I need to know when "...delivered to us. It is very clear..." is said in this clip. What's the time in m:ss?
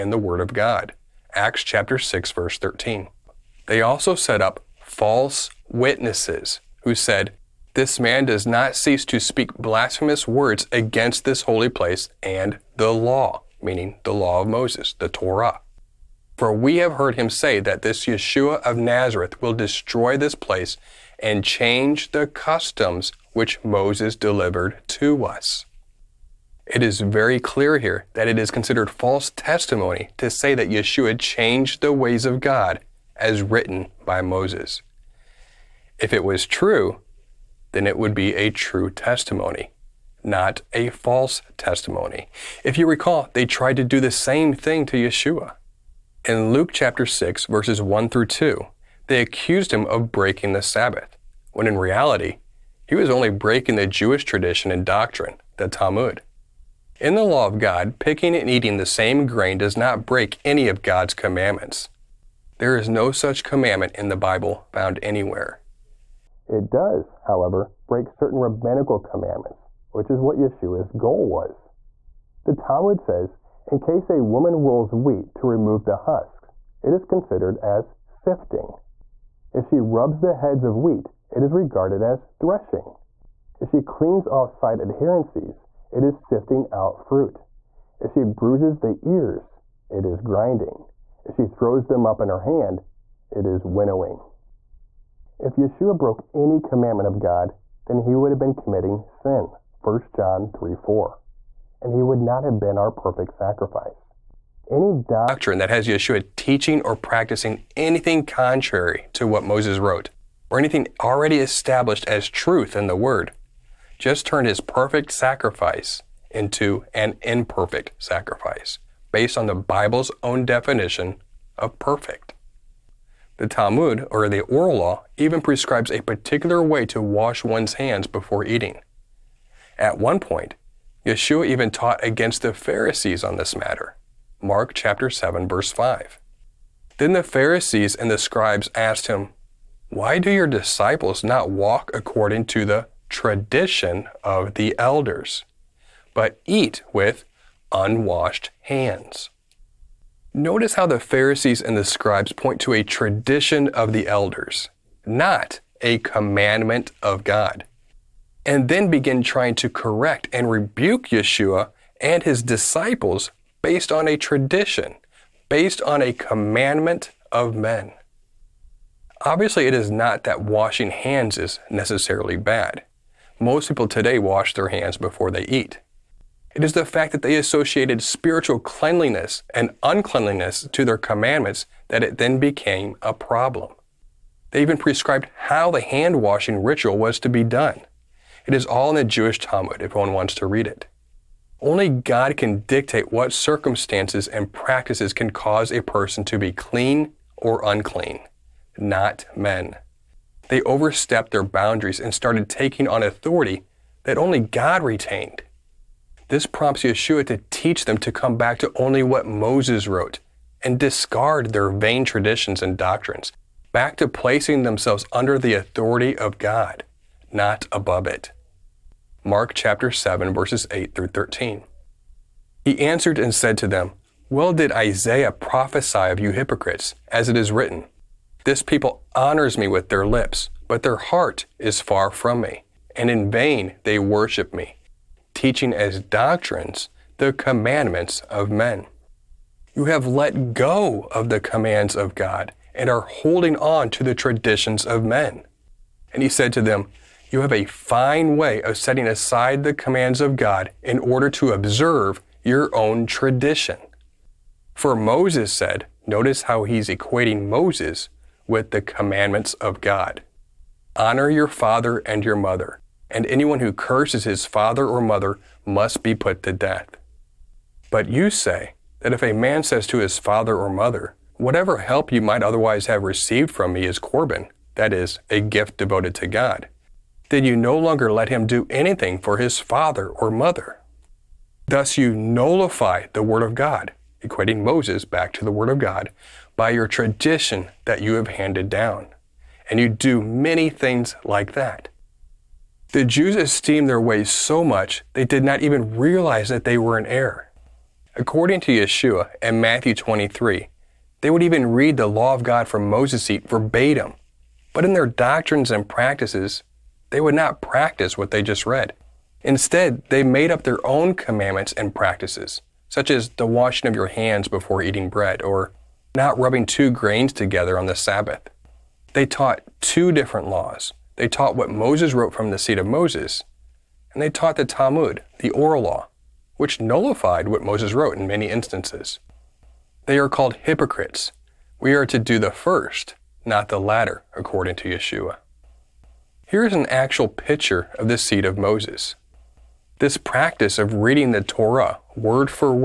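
0:24.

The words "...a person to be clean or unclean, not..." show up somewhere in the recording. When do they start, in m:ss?
3:15.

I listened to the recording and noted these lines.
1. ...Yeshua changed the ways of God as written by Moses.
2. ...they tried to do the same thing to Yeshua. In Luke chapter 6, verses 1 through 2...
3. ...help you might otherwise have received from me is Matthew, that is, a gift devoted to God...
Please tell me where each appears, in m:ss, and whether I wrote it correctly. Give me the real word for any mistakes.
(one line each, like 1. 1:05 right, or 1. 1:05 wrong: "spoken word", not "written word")
1. 0:30 right
2. 0:43 right
3. 4:31 wrong: "Corban", not "Matthew".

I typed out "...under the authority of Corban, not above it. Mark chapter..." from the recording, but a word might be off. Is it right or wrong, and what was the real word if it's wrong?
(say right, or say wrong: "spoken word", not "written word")
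wrong: "God", not "Corban".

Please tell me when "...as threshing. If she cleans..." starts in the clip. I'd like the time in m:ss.
1:22.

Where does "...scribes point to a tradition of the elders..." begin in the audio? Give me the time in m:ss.
2:31.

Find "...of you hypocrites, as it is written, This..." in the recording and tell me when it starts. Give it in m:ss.
3:46.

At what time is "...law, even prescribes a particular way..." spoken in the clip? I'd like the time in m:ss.
2:04.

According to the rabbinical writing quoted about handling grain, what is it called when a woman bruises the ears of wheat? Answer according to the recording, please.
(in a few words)
grinding.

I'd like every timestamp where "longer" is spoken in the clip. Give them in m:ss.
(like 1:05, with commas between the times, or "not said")
4:37.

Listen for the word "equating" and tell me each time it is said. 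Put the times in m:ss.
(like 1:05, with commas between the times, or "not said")
4:16, 4:44.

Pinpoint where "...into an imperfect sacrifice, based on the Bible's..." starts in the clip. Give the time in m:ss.
1:56.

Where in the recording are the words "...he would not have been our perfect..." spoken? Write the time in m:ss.
1:41.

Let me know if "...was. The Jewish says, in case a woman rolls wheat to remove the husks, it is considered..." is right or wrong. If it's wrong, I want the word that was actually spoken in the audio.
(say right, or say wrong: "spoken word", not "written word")
wrong: "Talmud", not "Jewish".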